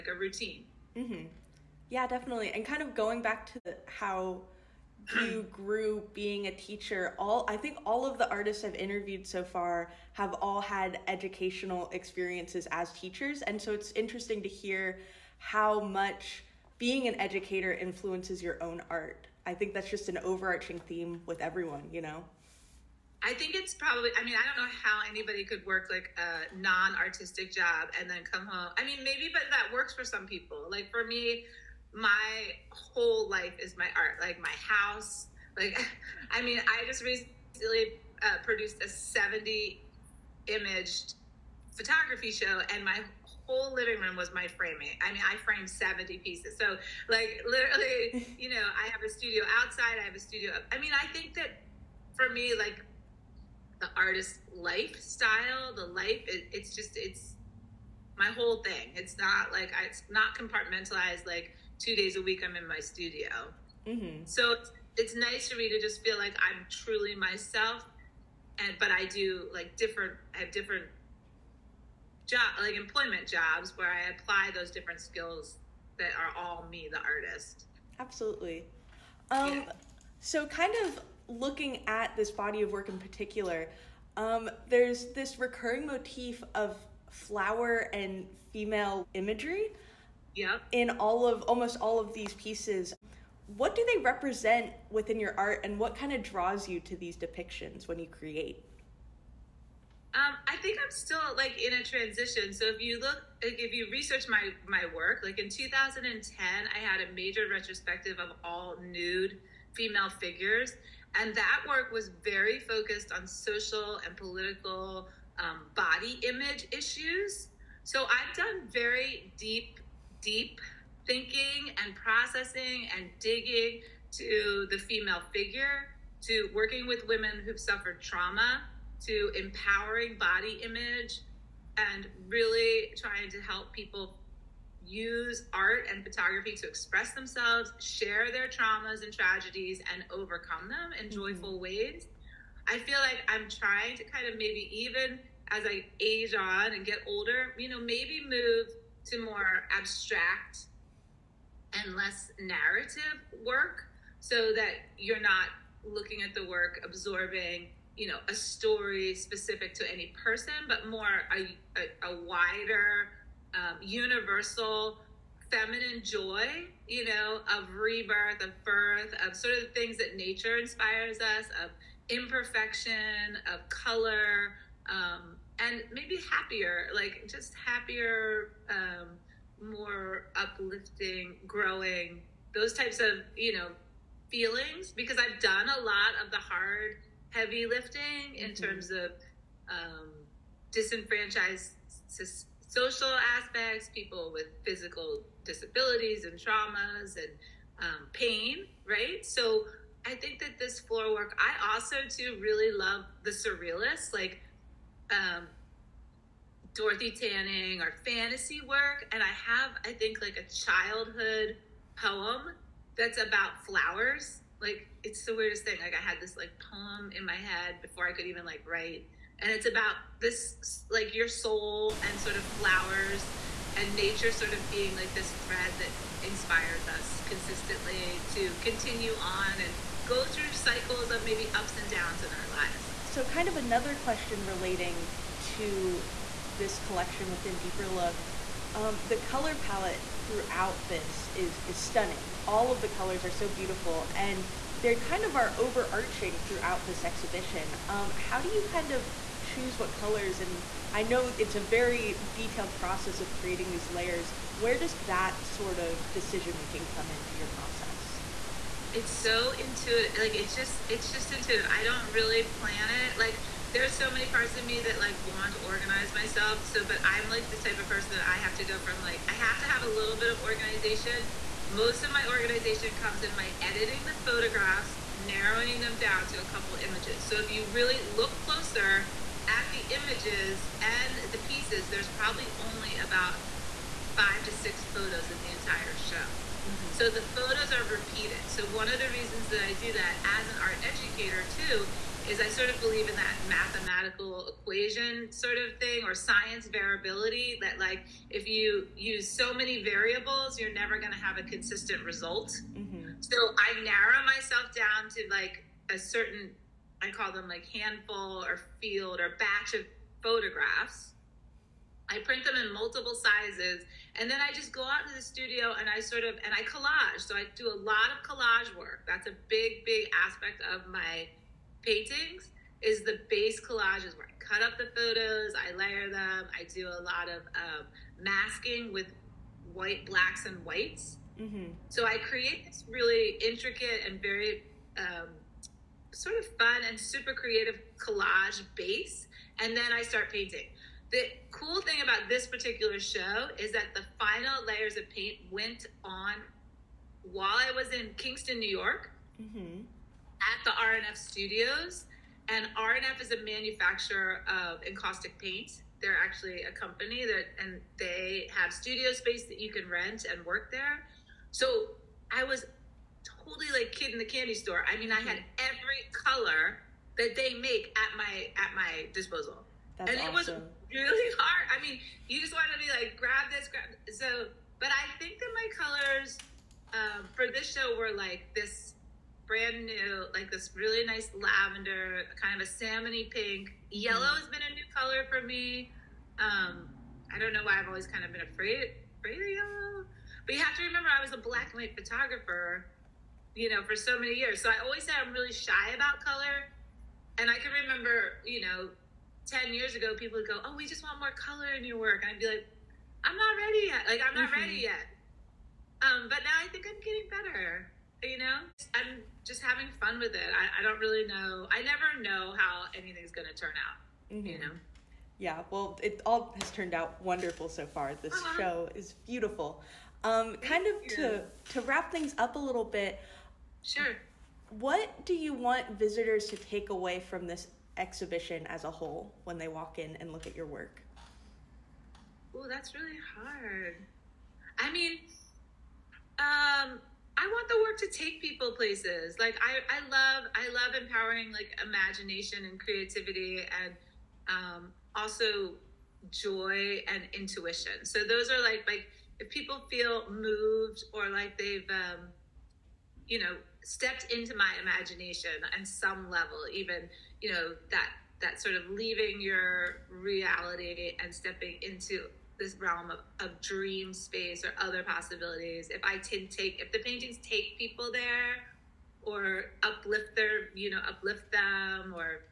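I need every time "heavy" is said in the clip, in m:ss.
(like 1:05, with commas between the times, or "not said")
3:07.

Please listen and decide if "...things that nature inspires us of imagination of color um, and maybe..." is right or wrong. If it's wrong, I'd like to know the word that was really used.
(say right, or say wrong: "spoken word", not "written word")
wrong: "imperfection", not "imagination".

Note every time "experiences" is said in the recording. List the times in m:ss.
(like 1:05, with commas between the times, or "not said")
0:11.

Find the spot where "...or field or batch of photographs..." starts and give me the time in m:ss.
5:08.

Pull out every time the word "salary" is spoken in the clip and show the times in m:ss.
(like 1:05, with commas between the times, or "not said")
not said.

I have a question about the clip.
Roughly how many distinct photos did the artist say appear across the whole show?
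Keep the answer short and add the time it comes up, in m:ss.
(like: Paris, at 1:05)
5 to 6, at 4:44.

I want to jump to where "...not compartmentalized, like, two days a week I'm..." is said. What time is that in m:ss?
1:00.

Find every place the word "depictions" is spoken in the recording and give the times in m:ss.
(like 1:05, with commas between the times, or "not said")
1:37.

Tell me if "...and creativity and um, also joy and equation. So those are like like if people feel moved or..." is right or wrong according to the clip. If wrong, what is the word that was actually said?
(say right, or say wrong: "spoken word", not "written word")
wrong: "intuition", not "equation".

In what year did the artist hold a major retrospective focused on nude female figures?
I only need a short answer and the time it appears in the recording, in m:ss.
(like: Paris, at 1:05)
2010, at 1:45.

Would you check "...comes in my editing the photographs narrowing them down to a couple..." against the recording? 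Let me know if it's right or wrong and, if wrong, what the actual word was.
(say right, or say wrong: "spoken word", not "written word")
right.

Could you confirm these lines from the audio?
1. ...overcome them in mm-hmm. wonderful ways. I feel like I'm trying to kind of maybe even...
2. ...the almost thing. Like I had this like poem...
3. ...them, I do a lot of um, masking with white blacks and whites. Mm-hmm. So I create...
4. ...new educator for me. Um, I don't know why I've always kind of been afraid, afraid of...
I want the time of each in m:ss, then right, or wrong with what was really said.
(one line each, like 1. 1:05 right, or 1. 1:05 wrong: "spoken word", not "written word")
1. 2:20 wrong: "joyful", not "wonderful"
2. 3:35 wrong: "weirdest", not "almost"
3. 5:26 right
4. 6:24 wrong: "color", not "educator".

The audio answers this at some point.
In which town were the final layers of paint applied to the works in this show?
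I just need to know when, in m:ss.
5:48.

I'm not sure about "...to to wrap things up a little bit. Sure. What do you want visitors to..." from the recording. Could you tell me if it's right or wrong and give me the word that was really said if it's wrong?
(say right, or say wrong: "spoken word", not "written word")
right.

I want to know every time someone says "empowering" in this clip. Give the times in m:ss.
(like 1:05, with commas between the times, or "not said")
2:09, 7:21.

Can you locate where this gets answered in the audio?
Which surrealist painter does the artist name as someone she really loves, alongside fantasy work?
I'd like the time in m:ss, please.
3:26.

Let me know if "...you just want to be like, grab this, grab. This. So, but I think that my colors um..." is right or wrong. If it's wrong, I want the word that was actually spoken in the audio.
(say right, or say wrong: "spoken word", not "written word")
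right.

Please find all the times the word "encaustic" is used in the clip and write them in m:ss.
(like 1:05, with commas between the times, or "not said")
5:54.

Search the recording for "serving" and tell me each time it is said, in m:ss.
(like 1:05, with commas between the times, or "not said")
not said.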